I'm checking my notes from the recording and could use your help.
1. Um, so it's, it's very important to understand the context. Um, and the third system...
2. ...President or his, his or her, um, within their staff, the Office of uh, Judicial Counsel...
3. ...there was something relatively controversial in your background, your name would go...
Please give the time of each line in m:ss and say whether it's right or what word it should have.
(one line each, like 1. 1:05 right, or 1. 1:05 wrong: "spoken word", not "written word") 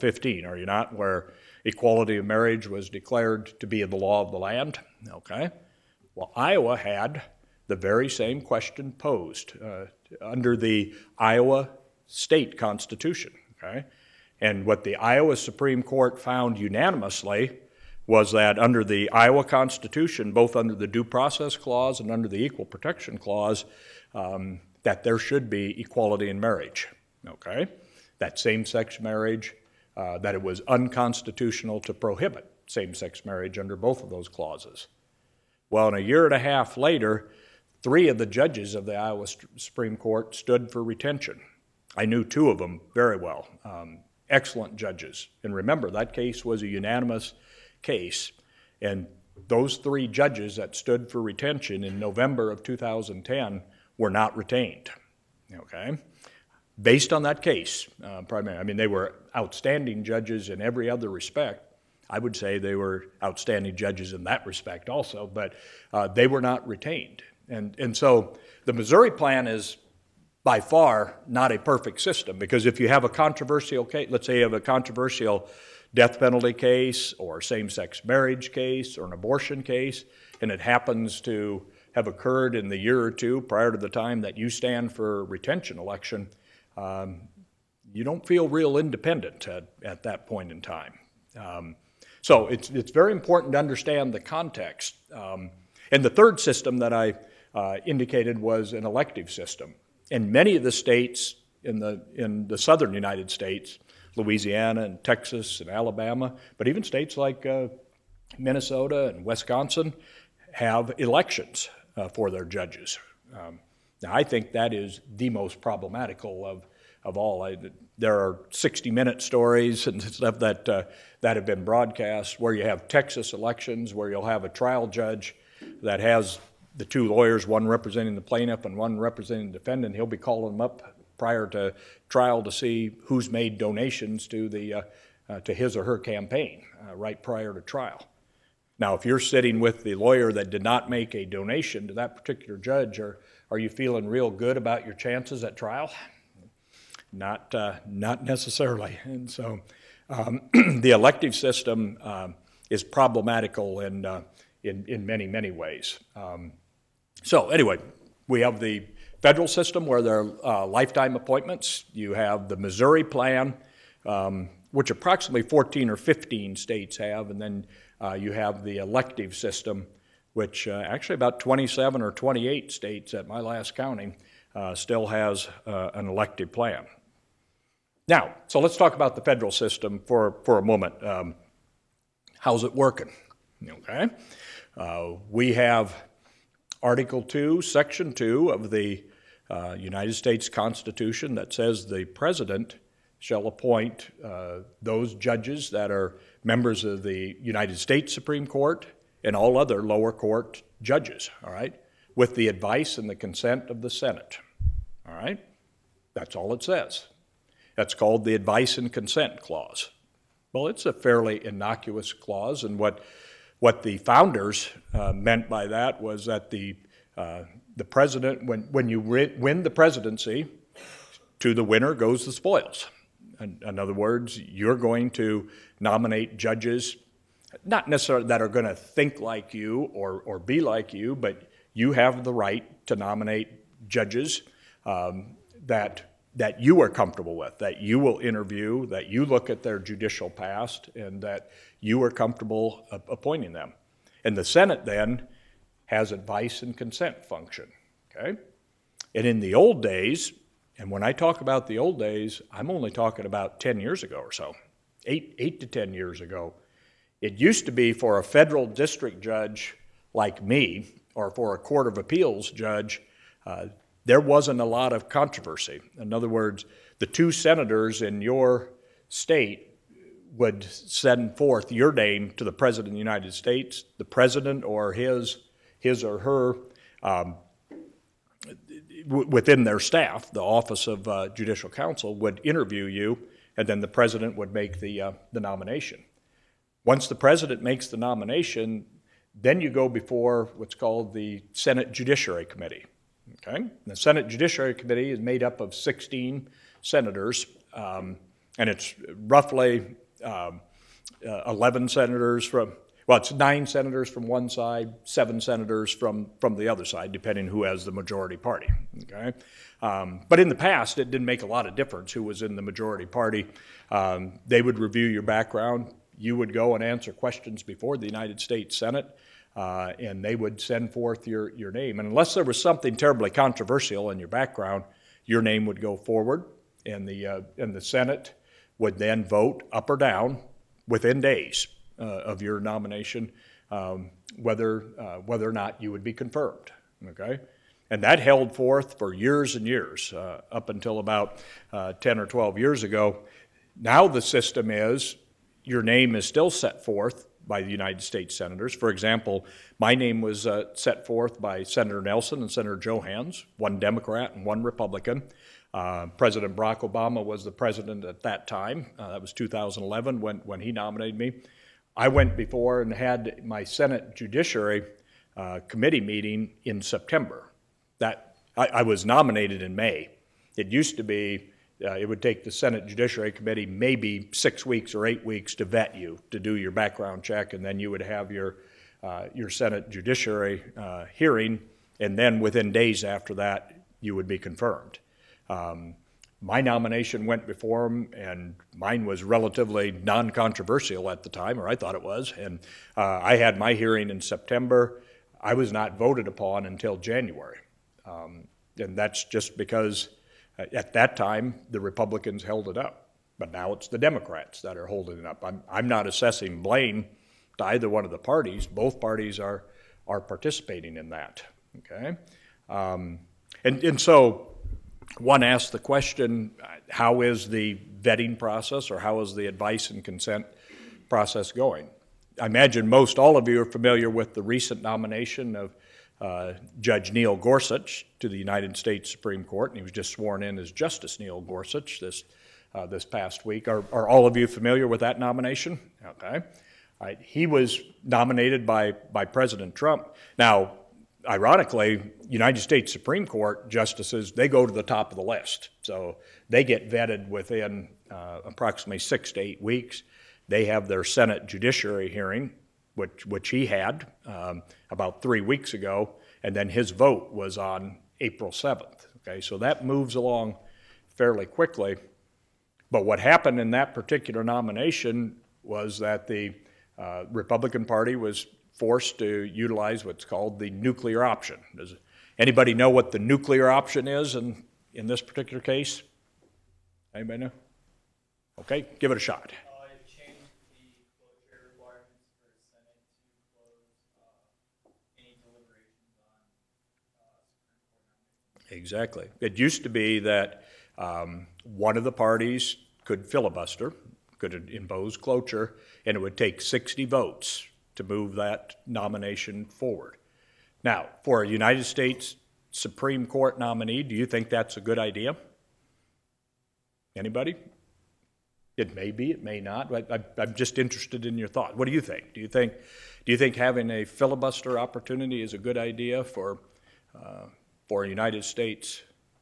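1. 1:31 right
2. 4:34 right
3. 5:22 wrong: "terribly", not "relatively".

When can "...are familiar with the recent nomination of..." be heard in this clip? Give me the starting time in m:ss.
7:03.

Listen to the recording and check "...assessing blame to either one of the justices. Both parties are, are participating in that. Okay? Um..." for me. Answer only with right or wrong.
wrong.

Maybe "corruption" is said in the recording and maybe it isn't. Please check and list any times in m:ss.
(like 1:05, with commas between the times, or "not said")
not said.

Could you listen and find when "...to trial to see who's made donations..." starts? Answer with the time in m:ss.
2:11.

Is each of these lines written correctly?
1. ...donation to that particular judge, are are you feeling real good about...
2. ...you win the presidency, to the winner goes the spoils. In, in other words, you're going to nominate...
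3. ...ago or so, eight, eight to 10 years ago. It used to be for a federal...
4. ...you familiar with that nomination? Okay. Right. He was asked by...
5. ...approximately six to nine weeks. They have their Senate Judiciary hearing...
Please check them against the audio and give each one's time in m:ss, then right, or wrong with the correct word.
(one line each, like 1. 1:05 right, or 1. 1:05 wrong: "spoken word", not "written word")
1. 2:21 right
2. 3:38 right
3. 4:14 right
4. 7:14 wrong: "nominated", not "asked"
5. 7:28 wrong: "eight", not "nine".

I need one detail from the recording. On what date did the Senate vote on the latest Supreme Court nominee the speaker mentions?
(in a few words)
April 7.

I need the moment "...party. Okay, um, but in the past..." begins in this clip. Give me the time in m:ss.
5:08.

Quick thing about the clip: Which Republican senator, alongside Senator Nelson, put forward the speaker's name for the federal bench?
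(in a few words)
Johanns.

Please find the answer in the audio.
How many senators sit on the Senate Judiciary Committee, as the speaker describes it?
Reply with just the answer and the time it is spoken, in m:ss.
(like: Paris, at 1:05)
16, at 4:55.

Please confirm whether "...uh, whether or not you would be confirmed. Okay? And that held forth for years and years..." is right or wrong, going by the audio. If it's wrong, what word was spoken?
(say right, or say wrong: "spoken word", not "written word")
right.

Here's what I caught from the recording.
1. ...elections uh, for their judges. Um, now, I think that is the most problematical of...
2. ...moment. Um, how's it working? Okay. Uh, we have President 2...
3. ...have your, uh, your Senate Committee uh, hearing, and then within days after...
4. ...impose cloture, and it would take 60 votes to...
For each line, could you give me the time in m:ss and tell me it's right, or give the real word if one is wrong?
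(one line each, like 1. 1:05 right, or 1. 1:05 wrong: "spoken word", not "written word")
1. 1:50 right
2. 3:00 wrong: "Article", not "President"
3. 6:18 wrong: "Judiciary", not "Committee"
4. 8:14 right.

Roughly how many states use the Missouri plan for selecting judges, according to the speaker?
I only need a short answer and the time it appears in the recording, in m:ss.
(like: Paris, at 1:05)
14 or 15, at 2:45.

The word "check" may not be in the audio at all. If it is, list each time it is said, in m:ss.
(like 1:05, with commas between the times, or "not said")
6:17.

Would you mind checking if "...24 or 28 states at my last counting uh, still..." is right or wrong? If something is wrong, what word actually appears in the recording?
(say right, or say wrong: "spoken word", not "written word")
wrong: "27", not "24".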